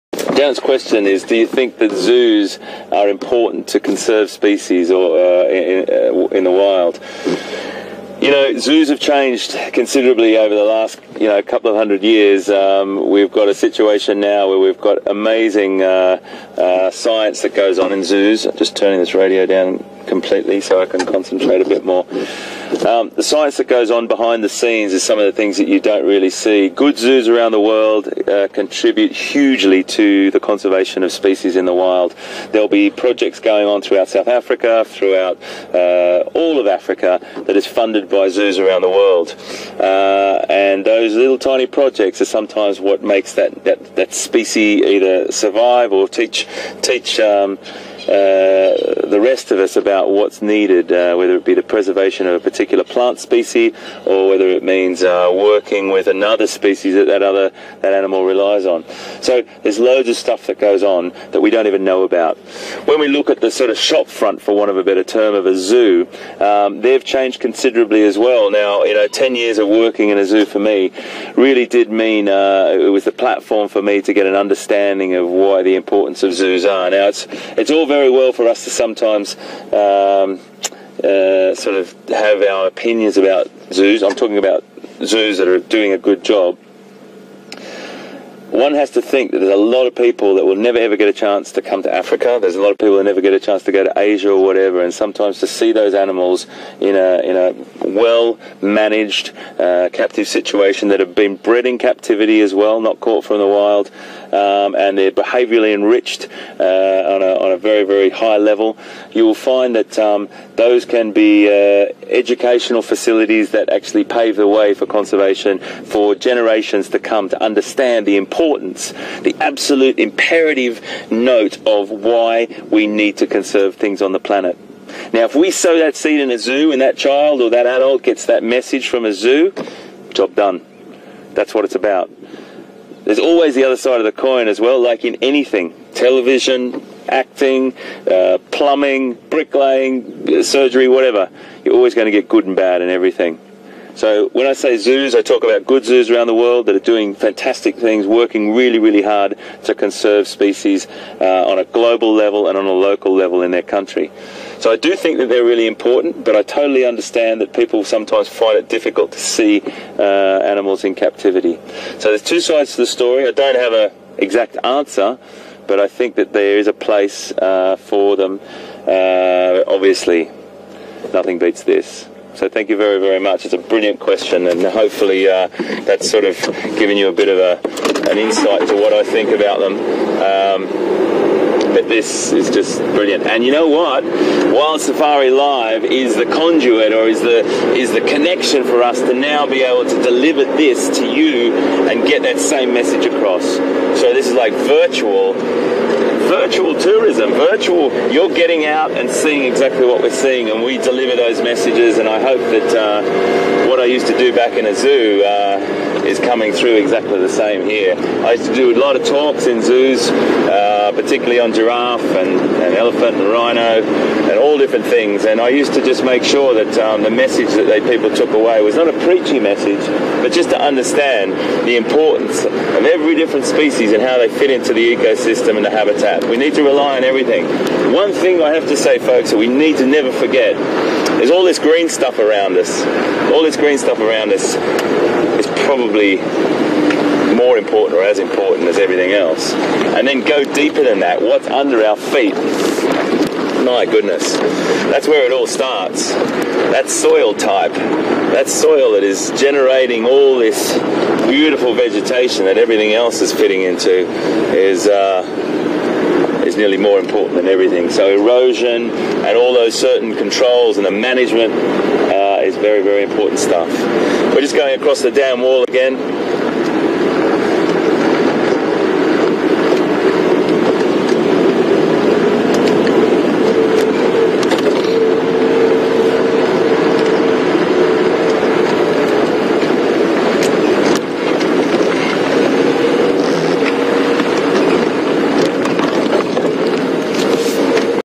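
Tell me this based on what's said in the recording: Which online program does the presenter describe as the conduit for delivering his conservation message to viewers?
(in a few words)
Wild Safari Live.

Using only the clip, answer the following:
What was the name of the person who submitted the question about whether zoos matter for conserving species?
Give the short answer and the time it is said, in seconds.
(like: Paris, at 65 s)
Janet, at 0 s.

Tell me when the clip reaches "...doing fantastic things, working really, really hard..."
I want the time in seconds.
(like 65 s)
146 s.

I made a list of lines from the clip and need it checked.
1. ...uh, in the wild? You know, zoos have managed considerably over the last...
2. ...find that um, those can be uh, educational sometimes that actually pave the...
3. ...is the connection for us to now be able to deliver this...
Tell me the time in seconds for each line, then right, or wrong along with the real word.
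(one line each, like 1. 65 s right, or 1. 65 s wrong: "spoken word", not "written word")
1. 5 s wrong: "changed", not "managed"
2. 109 s wrong: "facilities", not "sometimes"
3. 187 s right.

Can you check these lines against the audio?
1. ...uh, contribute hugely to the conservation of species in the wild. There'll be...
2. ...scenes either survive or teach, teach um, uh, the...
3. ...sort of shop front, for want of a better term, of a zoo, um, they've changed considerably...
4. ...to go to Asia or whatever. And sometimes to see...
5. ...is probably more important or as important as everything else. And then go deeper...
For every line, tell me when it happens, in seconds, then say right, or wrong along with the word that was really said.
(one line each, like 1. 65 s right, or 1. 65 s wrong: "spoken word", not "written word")
1. 28 s right
2. 44 s wrong: "species", not "scenes"
3. 63 s right
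4. 93 s right
5. 235 s right.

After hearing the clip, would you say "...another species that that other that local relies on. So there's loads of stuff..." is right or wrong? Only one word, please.
wrong.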